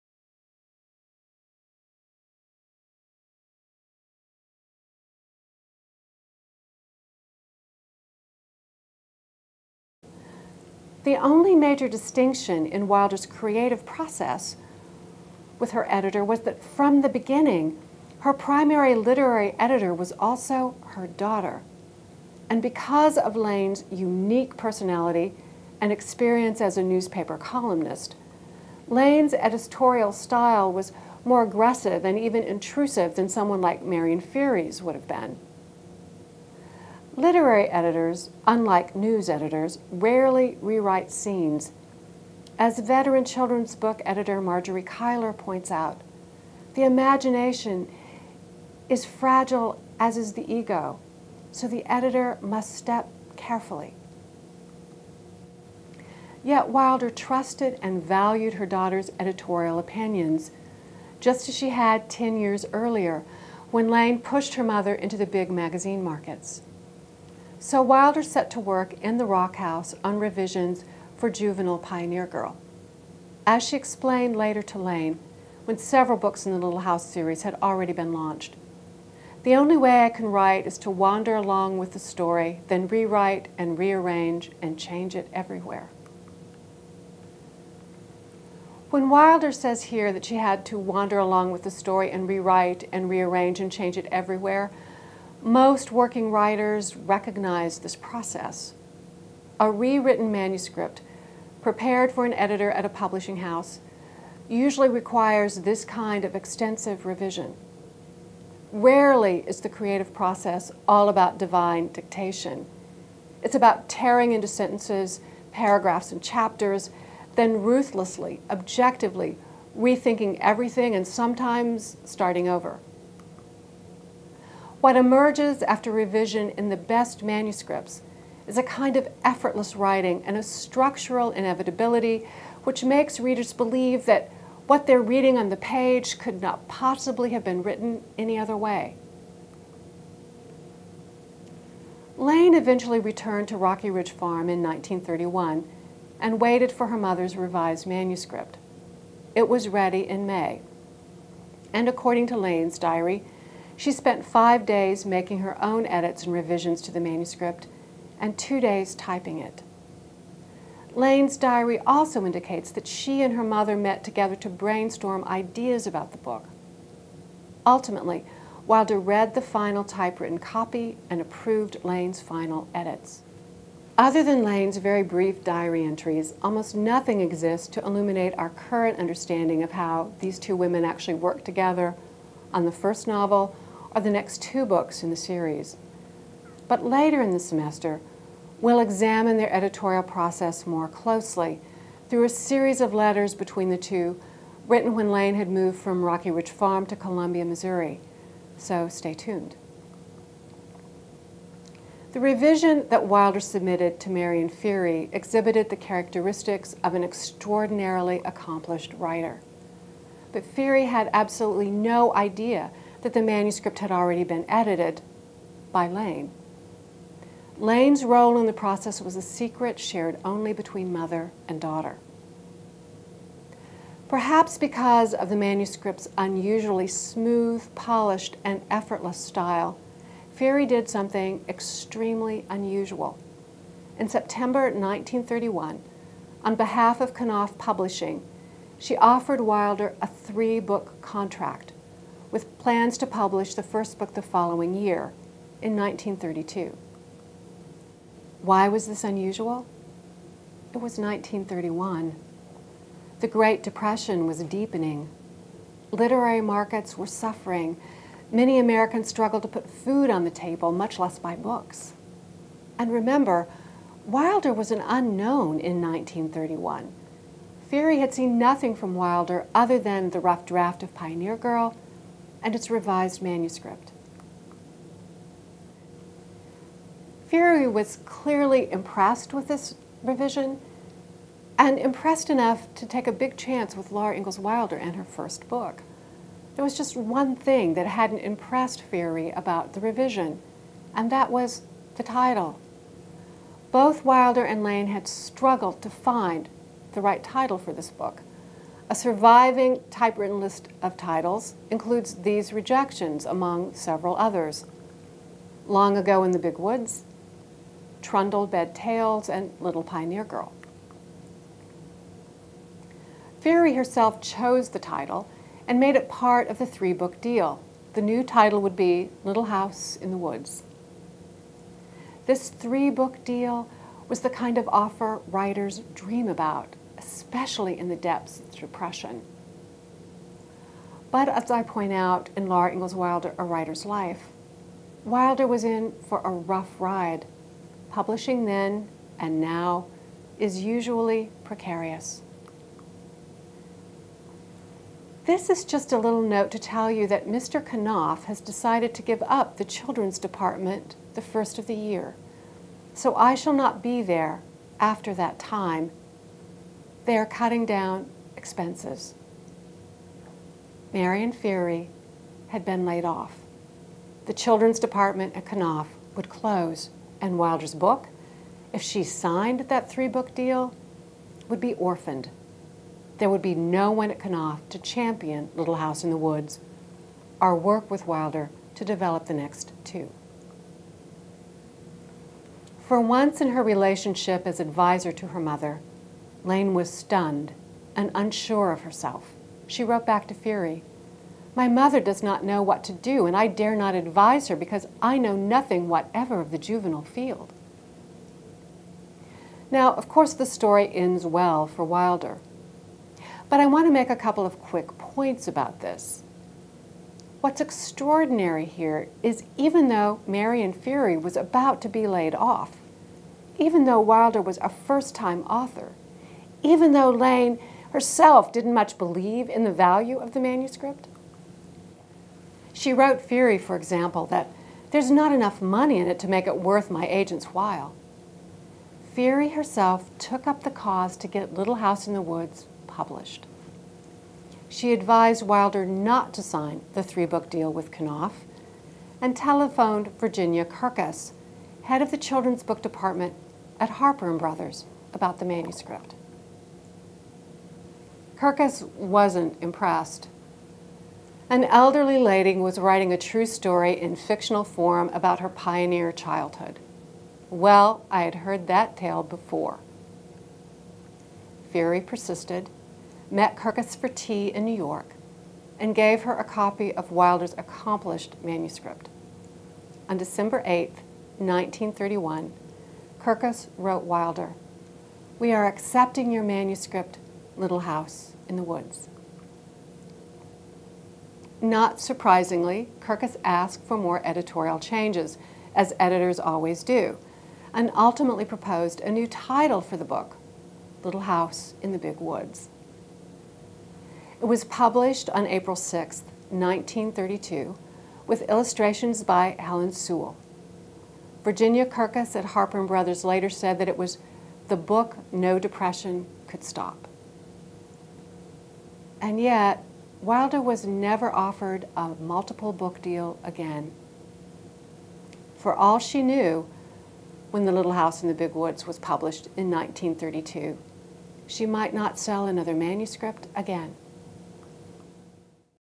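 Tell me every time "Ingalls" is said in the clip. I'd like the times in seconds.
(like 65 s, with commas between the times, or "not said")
284 s, 332 s.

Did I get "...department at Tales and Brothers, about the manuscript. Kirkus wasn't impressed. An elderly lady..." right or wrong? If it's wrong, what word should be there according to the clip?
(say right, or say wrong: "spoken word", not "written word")
wrong: "Harper", not "Tales".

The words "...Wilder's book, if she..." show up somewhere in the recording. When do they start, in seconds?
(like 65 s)
367 s.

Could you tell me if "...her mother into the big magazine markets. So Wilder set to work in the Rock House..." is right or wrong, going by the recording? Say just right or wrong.
right.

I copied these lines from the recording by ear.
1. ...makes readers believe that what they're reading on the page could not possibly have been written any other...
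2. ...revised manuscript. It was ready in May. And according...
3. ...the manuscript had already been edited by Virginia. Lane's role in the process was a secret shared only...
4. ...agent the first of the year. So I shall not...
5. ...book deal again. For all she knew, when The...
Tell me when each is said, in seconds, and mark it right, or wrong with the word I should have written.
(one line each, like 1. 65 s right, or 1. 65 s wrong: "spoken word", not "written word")
1. 132 s right
2. 147 s right
3. 213 s wrong: "Lane", not "Virginia"
4. 350 s wrong: "department", not "agent"
5. 512 s right.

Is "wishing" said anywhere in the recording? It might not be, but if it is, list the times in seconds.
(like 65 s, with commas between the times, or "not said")
not said.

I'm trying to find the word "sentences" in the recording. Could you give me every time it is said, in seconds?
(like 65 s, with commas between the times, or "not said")
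114 s.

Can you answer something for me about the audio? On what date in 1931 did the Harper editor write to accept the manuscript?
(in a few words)
December 8.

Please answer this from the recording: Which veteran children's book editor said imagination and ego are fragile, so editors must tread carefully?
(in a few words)
Marjorie Kyler.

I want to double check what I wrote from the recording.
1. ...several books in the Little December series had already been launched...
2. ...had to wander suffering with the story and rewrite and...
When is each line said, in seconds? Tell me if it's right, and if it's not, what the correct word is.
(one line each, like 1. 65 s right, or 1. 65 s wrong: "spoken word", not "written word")
1. 75 s wrong: "House", not "December"
2. 90 s wrong: "along", not "suffering".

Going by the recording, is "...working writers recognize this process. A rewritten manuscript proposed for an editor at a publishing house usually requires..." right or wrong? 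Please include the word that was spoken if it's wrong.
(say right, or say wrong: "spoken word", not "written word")
wrong: "prepared", not "proposed".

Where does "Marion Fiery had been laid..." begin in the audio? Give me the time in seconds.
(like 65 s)
360 s.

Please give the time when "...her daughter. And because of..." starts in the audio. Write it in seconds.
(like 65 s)
20 s.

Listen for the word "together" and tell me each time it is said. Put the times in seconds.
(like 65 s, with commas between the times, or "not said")
164 s, 181 s.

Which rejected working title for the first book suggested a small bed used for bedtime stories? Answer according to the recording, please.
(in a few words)
Trundle Bed Tales.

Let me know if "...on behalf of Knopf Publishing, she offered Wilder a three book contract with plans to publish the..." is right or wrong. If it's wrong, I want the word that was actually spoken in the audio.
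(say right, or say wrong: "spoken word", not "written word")
right.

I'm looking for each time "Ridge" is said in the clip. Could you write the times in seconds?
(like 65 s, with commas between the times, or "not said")
143 s, 196 s.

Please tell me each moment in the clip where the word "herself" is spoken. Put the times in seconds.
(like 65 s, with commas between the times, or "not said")
313 s, 388 s, 417 s, 429 s.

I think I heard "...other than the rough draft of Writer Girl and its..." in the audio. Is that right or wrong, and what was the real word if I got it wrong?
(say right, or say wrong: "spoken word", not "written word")
wrong: "Pioneer", not "Writer".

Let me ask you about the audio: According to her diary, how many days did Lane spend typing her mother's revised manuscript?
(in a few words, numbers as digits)
2.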